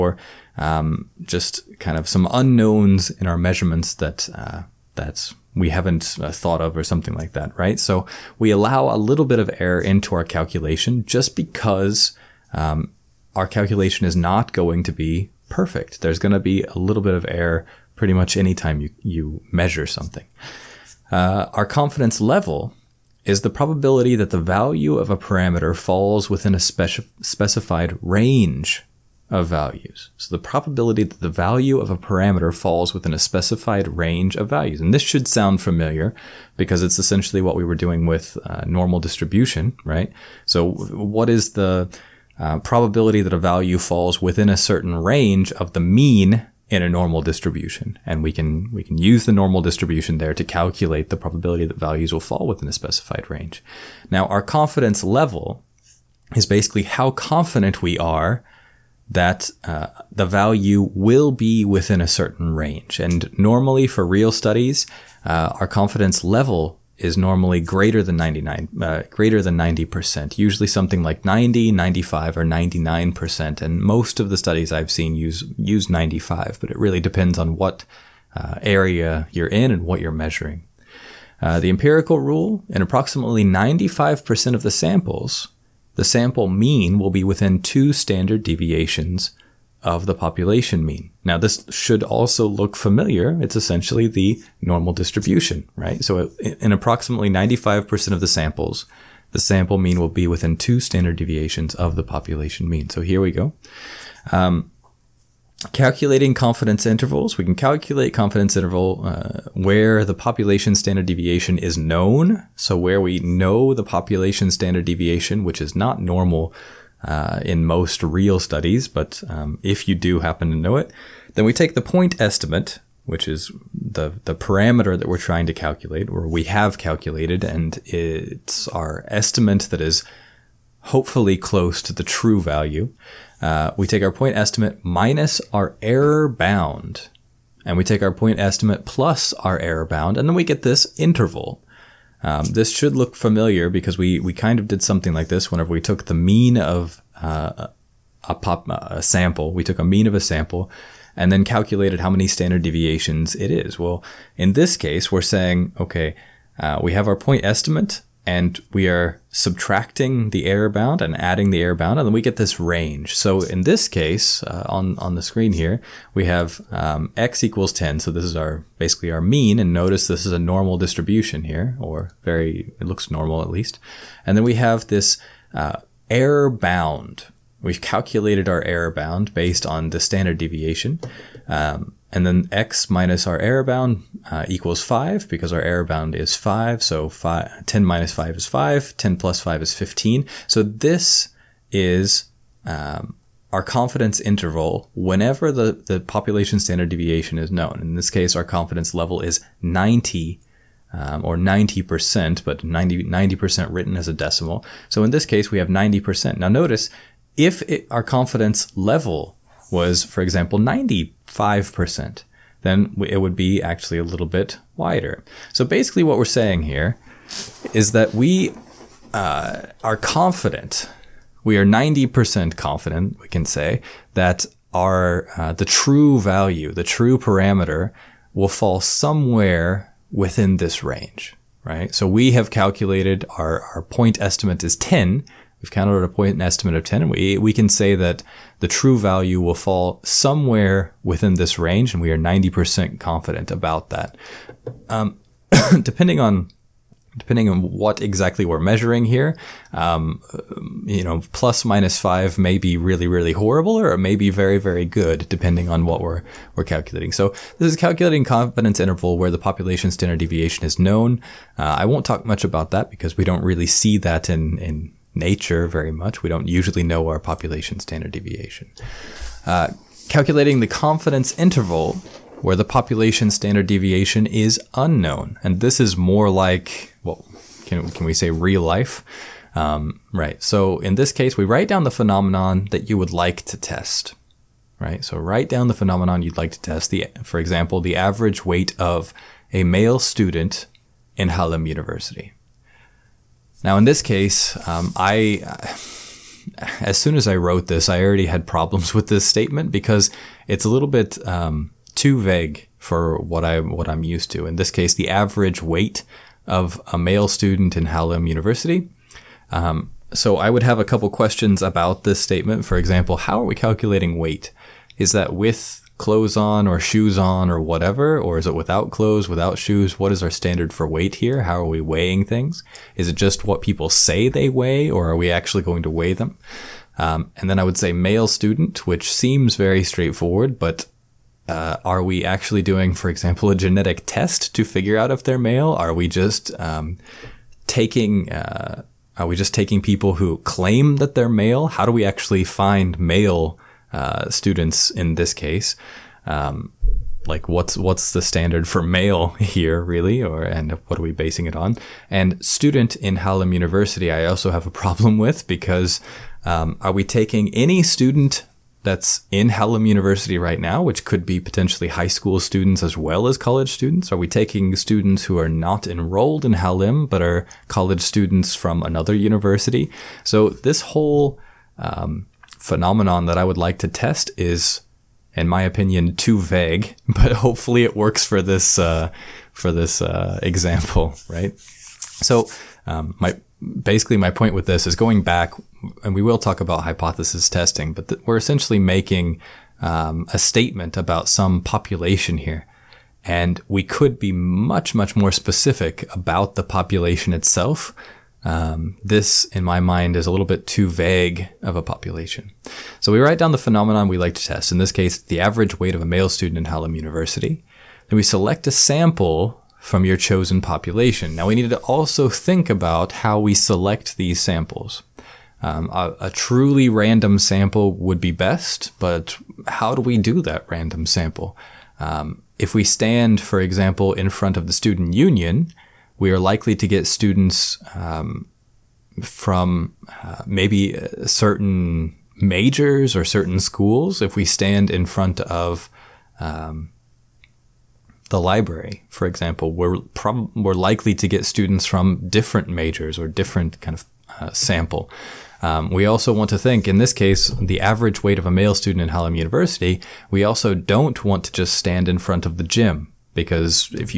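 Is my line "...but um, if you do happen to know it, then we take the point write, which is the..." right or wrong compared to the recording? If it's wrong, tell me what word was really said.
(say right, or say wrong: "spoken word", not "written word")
wrong: "estimate", not "write".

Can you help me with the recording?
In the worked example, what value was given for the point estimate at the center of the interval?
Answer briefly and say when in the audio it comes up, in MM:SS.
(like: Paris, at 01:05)
10, at 02:47.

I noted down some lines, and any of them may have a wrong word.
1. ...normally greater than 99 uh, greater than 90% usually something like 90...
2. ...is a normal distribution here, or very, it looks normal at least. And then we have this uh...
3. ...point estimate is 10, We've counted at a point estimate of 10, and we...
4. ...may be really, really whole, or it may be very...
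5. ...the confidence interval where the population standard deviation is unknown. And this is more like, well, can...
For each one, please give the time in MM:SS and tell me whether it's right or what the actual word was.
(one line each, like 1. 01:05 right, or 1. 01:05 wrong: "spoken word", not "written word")
1. 01:07 right
2. 02:50 right
3. 03:53 right
4. 04:12 wrong: "horrible", not "whole"
5. 04:30 right.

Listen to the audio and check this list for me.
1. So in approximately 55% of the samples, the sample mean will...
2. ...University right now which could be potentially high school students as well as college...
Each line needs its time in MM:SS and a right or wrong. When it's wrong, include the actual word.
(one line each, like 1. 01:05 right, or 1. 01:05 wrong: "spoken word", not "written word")
1. 01:36 wrong: "95", not "55"
2. 05:59 right.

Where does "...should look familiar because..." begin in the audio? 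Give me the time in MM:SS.
02:22.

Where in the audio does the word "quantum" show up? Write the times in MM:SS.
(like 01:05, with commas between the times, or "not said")
not said.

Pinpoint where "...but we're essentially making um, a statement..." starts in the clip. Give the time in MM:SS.
06:27.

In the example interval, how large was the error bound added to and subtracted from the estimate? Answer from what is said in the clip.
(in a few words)
5.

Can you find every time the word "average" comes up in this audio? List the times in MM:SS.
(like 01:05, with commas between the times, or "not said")
04:47, 05:05, 06:45, 07:27.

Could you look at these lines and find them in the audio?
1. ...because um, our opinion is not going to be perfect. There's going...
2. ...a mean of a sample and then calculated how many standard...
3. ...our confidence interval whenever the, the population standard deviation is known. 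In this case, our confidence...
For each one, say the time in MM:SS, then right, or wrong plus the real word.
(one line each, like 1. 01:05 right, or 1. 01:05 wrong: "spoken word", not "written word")
1. 00:11 wrong: "calculation", not "opinion"
2. 02:29 right
3. 03:13 right.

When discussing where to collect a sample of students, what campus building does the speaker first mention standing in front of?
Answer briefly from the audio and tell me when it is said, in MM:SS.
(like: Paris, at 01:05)
student union, at 07:04.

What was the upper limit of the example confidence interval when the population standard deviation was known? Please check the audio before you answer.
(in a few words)
15.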